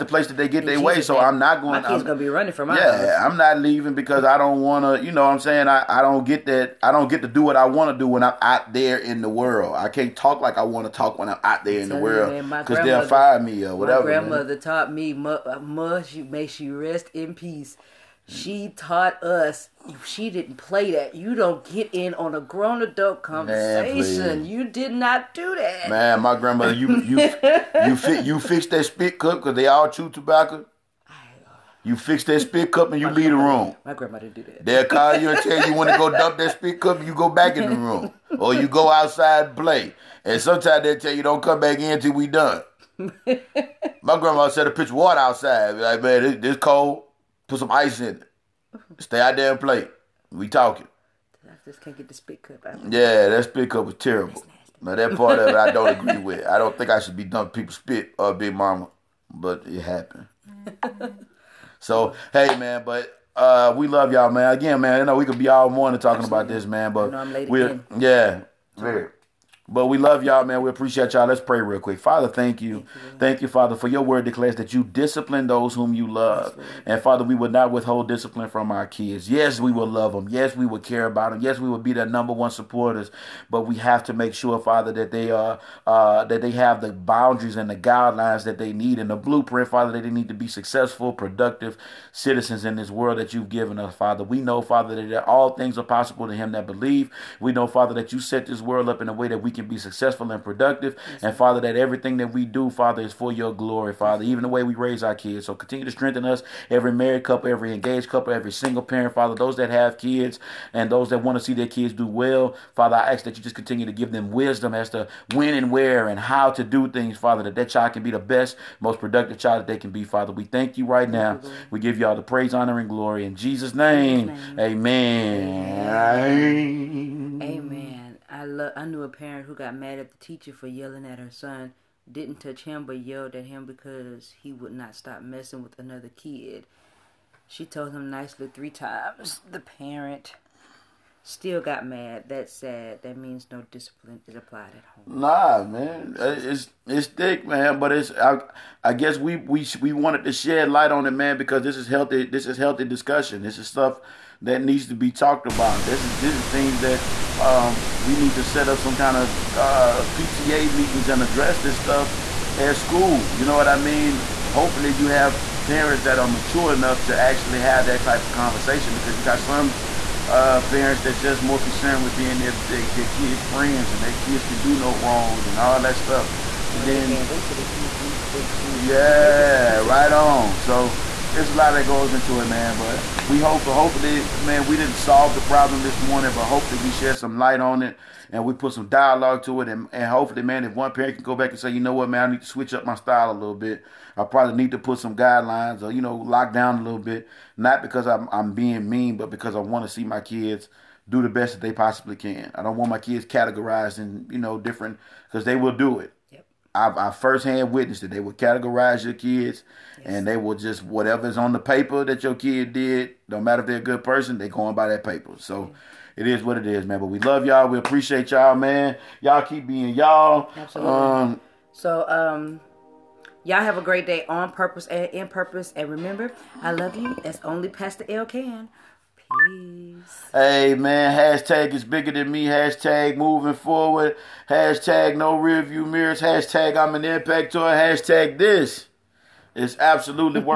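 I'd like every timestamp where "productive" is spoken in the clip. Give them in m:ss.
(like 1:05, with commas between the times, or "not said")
1:31, 1:40, 1:58.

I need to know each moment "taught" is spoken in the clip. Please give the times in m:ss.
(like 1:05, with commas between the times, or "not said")
0:14, 0:18.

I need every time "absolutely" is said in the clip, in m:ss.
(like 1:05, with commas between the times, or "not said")
1:06, 3:40, 3:59.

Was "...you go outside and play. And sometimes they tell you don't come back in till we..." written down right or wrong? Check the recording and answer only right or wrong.
right.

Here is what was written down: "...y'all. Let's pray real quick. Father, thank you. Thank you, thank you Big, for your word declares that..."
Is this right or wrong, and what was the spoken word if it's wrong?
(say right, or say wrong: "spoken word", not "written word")
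wrong: "Father", not "Big".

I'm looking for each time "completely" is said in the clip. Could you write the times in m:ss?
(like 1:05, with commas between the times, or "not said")
not said.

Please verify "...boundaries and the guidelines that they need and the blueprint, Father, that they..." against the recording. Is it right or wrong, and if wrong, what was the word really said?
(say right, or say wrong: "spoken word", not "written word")
right.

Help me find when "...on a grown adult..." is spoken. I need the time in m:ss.
0:22.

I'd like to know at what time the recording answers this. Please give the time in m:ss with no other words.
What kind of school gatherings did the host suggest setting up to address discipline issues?
2:40.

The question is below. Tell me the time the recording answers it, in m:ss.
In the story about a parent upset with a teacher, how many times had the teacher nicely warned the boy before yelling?
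2:18.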